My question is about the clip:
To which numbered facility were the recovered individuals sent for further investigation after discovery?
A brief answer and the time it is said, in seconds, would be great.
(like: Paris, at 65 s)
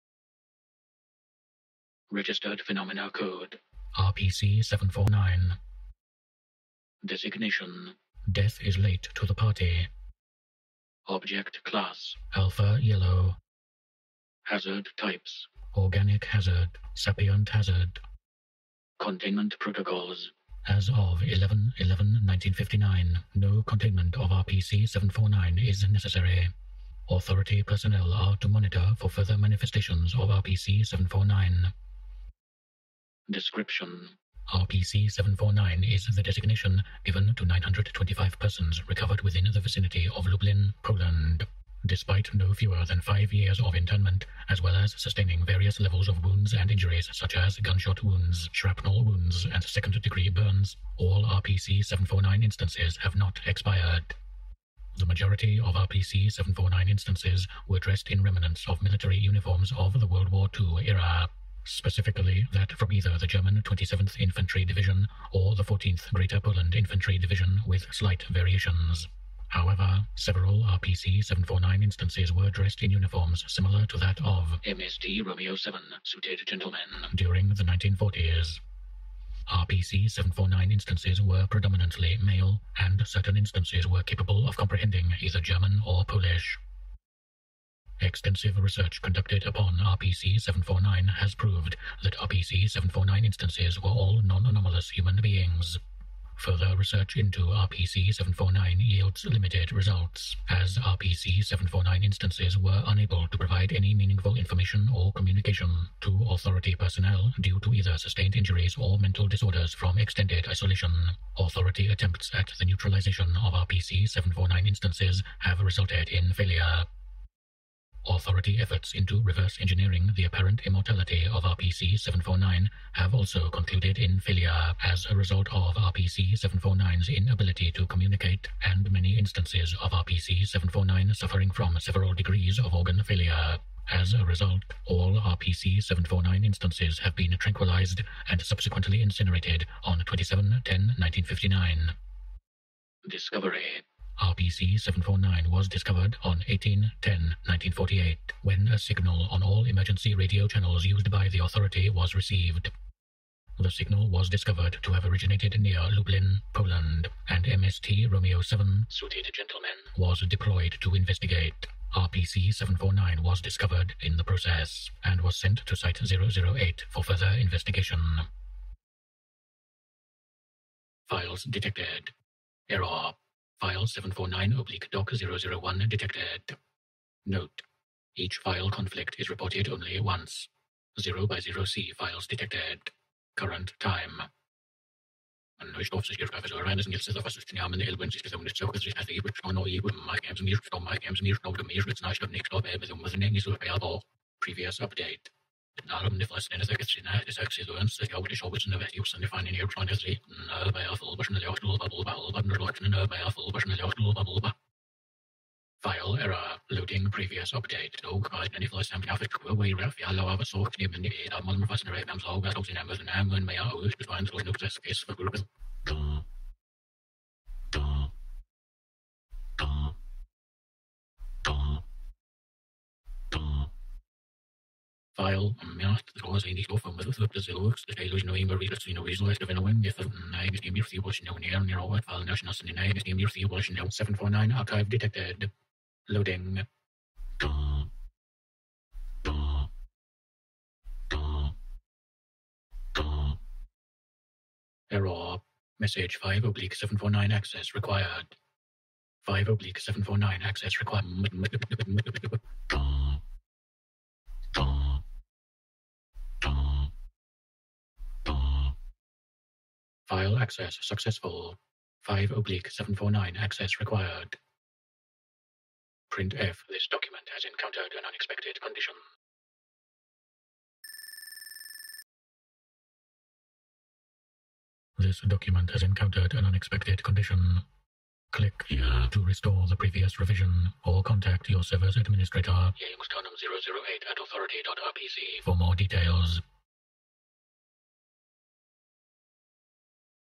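Site 008, at 165 s.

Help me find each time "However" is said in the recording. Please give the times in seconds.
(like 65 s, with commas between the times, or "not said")
69 s.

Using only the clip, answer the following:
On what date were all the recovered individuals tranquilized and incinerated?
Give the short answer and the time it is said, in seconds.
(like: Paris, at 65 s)
27 10 1959, at 139 s.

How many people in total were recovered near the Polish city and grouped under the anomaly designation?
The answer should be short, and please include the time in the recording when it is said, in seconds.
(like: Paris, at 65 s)
925, at 37 s.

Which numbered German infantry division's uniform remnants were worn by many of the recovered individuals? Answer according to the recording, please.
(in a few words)
27th Infantry Division.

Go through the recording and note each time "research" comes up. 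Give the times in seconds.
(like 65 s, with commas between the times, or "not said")
88 s, 96 s.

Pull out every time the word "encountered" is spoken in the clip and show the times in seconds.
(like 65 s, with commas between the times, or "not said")
267 s, 275 s.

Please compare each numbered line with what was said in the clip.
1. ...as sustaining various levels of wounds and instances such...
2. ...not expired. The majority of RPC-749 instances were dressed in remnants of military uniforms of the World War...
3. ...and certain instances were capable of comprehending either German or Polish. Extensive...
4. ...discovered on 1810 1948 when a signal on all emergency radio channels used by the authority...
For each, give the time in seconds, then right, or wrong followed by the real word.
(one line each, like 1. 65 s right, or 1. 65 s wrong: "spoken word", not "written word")
1. 44 s wrong: "injuries", not "instances"
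2. 53 s right
3. 82 s right
4. 145 s right.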